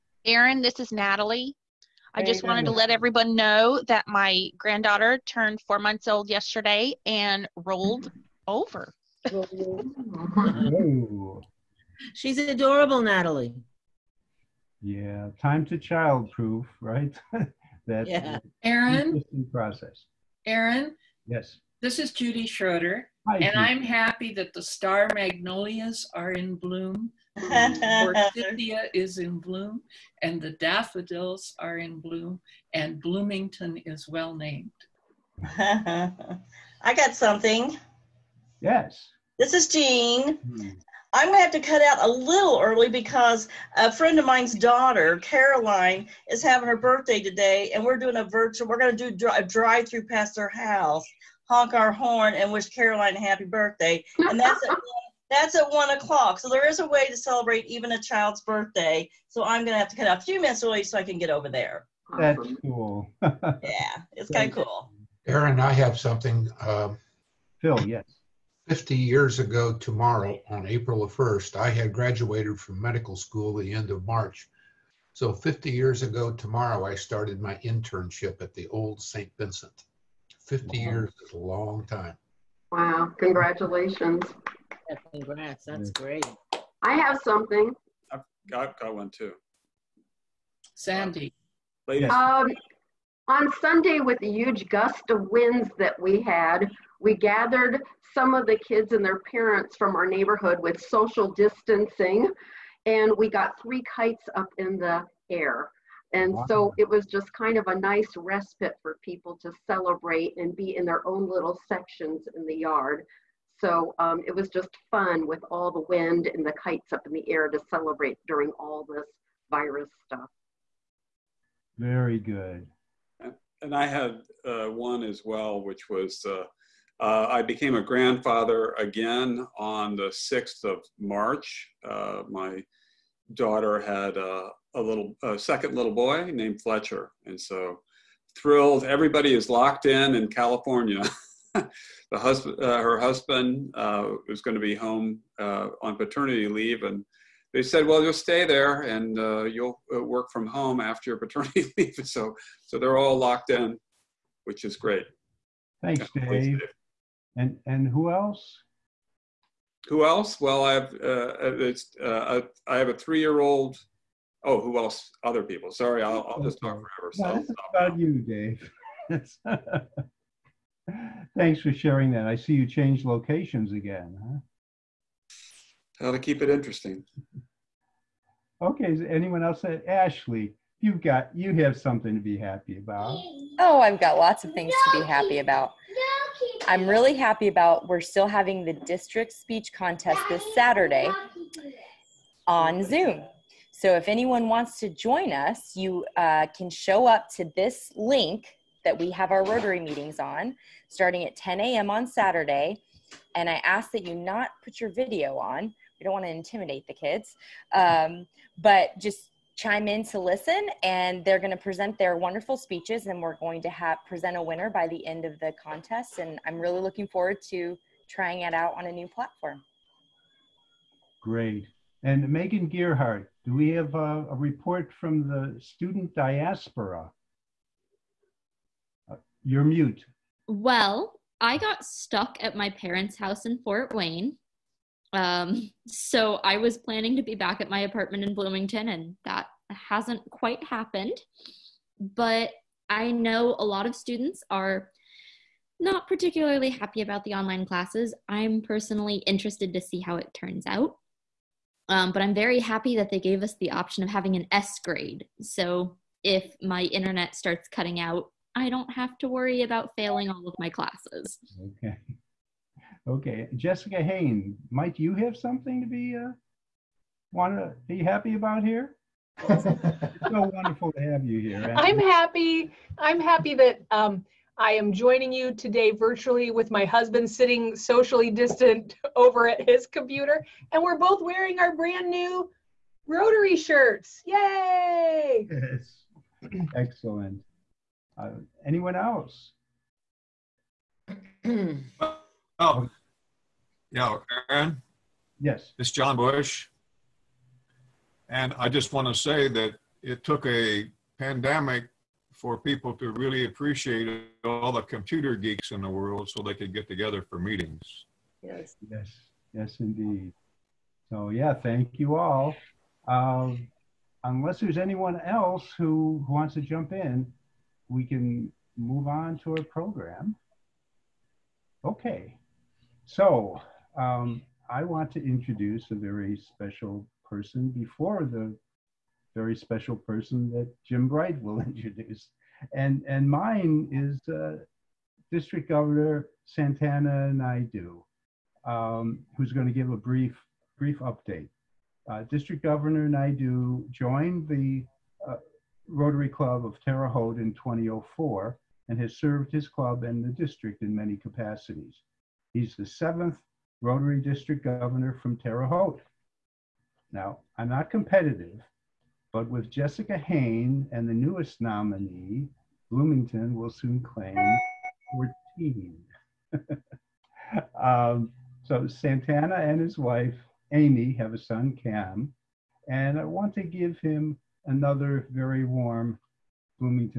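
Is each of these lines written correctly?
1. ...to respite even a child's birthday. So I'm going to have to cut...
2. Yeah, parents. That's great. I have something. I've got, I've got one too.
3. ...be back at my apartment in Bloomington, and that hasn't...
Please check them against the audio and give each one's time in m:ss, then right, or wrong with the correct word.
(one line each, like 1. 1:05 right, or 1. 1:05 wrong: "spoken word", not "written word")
1. 0:57 wrong: "celebrate", not "respite"
2. 1:24 wrong: "congrats", not "parents"
3. 3:57 right.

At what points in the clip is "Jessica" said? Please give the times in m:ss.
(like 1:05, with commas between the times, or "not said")
4:23, 5:59.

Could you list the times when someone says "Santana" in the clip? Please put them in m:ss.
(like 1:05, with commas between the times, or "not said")
5:36, 6:08.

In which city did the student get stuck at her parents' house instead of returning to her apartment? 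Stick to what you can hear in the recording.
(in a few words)
Fort Wayne.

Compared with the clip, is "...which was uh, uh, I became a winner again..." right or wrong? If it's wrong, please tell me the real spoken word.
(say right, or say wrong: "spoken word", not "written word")
wrong: "grandfather", not "winner".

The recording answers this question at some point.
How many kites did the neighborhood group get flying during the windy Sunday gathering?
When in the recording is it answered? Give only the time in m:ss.
1:43.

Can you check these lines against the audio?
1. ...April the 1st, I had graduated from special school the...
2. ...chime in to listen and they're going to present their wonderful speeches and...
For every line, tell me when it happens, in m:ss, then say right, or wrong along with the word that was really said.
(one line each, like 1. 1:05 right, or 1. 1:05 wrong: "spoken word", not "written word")
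1. 1:10 wrong: "medical", not "special"
2. 3:29 right.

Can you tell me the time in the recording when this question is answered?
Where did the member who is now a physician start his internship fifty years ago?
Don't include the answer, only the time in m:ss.
1:19.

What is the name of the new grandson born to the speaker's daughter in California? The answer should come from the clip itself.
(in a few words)
Fletcher.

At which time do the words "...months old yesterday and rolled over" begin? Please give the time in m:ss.
0:05.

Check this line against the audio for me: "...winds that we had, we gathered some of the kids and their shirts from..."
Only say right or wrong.
wrong.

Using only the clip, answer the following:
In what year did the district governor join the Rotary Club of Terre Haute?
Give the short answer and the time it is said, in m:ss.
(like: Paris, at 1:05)
2004, at 5:47.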